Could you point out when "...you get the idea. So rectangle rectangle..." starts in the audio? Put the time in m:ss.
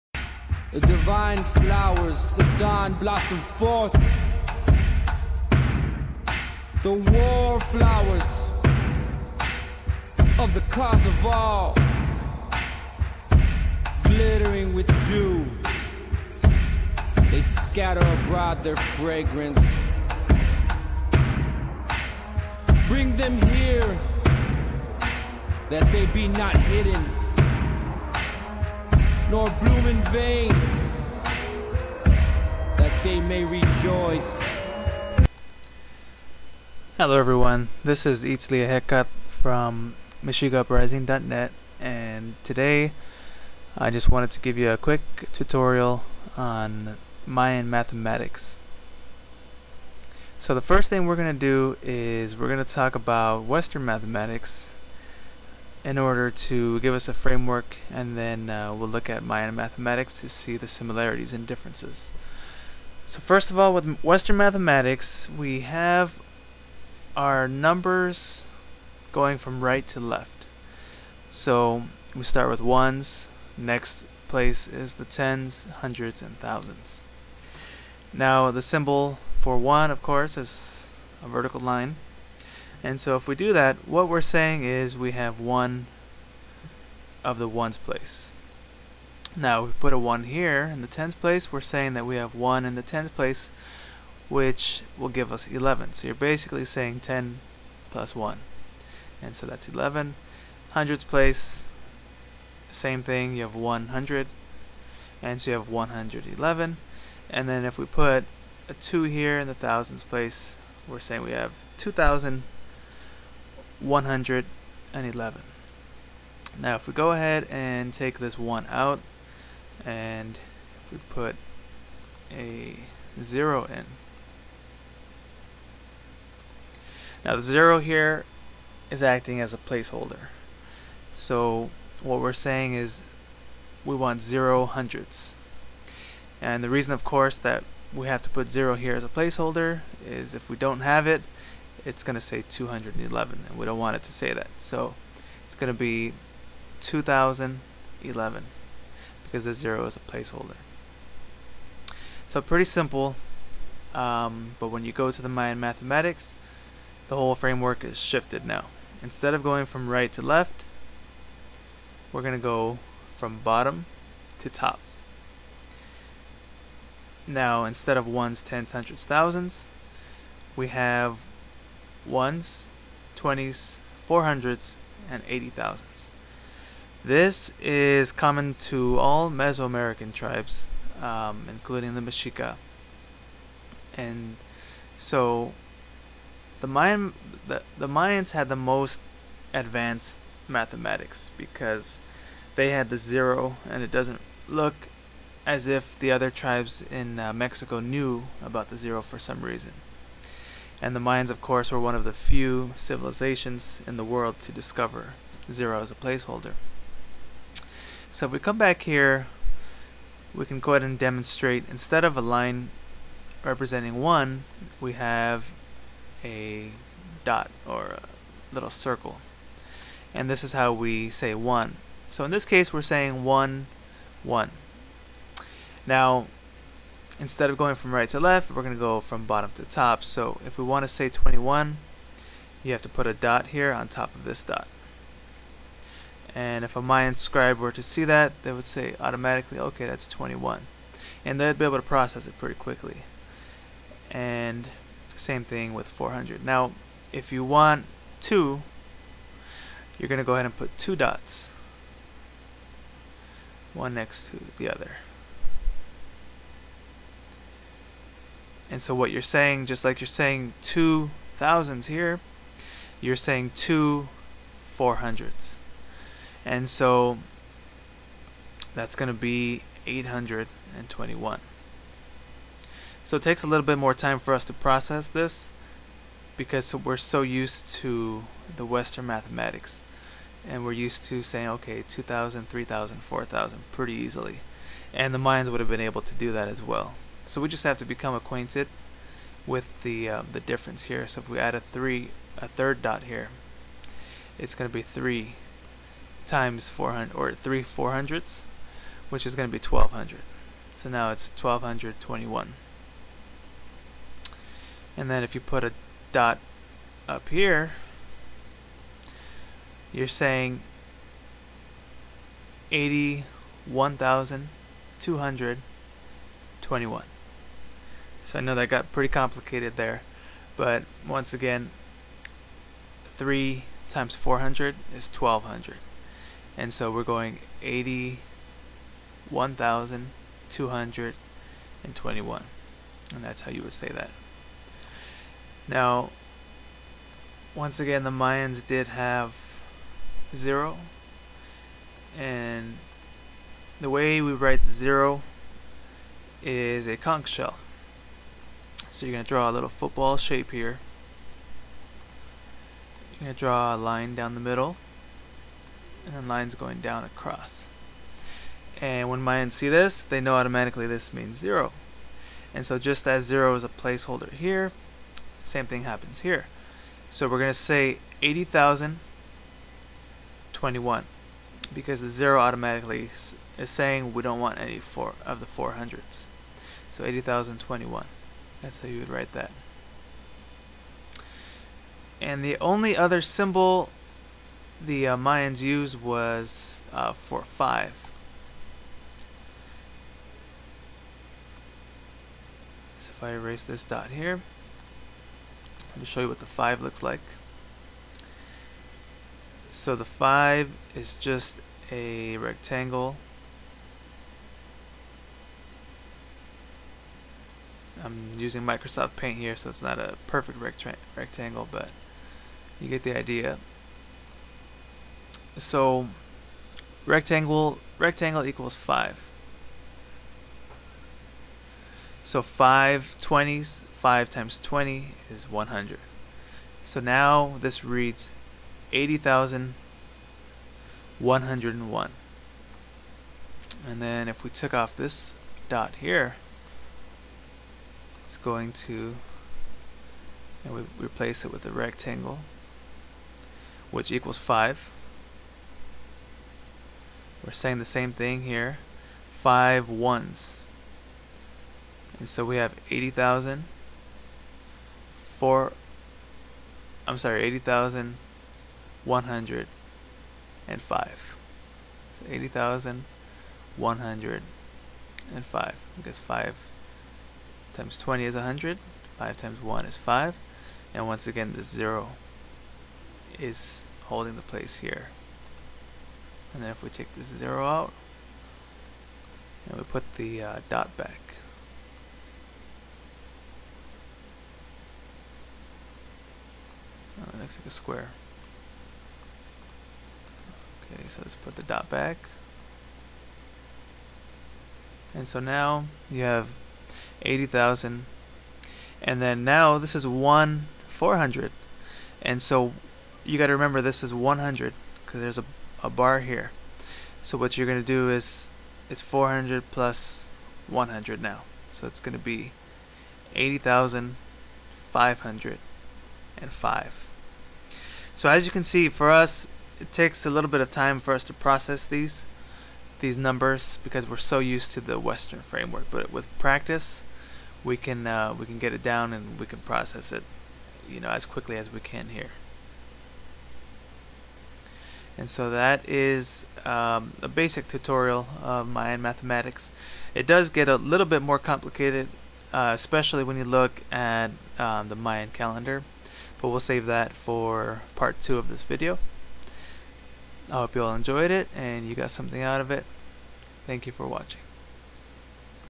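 6:52.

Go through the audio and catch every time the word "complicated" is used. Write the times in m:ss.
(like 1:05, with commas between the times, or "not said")
5:19, 9:01.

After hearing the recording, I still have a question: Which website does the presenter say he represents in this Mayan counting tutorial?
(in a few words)
MexicaUprising.net.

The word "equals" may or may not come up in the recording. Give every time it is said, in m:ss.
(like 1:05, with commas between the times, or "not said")
6:58, 7:24.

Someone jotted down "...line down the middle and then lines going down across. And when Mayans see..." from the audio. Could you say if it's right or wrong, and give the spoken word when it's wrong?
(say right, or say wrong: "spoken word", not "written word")
right.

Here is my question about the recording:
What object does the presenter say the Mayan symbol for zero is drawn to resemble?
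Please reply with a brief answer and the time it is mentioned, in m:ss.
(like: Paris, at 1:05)
a conch shell, at 5:46.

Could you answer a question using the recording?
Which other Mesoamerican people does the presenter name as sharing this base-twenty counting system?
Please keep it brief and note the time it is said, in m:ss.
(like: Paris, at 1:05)
the Mexica, at 3:01.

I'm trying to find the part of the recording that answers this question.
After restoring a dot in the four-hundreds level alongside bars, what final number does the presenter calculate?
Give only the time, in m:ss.
8:33.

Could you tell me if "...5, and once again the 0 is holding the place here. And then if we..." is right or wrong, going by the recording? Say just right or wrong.
right.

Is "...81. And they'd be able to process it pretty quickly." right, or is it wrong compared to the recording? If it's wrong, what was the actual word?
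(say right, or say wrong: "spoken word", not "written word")
wrong: "21", not "81".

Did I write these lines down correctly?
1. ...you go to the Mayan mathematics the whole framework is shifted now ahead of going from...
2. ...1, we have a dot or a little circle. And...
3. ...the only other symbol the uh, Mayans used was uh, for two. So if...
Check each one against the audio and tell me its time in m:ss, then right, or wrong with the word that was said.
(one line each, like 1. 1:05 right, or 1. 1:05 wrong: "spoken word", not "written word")
1. 2:34 wrong: "instead", not "ahead"
2. 3:34 right
3. 6:22 wrong: "five", not "two".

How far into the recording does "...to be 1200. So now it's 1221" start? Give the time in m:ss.
4:59.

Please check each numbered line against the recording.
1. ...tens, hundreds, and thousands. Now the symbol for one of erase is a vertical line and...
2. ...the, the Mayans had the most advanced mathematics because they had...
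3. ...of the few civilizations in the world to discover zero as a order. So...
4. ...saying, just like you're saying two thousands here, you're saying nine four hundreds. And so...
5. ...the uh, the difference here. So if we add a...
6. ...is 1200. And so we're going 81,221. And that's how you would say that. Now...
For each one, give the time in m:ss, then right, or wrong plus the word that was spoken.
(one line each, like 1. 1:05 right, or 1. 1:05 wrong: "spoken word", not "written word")
1. 1:15 wrong: "course", not "erase"
2. 3:07 right
3. 3:21 wrong: "placeholder", not "order"
4. 4:19 wrong: "two", not "nine"
5. 4:49 right
6. 5:24 right.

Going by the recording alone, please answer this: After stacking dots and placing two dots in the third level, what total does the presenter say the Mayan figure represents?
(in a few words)
821.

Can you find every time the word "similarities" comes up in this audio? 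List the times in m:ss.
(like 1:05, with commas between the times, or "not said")
1:00.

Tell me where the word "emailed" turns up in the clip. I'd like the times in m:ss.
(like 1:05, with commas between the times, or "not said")
not said.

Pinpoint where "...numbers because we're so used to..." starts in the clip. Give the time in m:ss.
8:43.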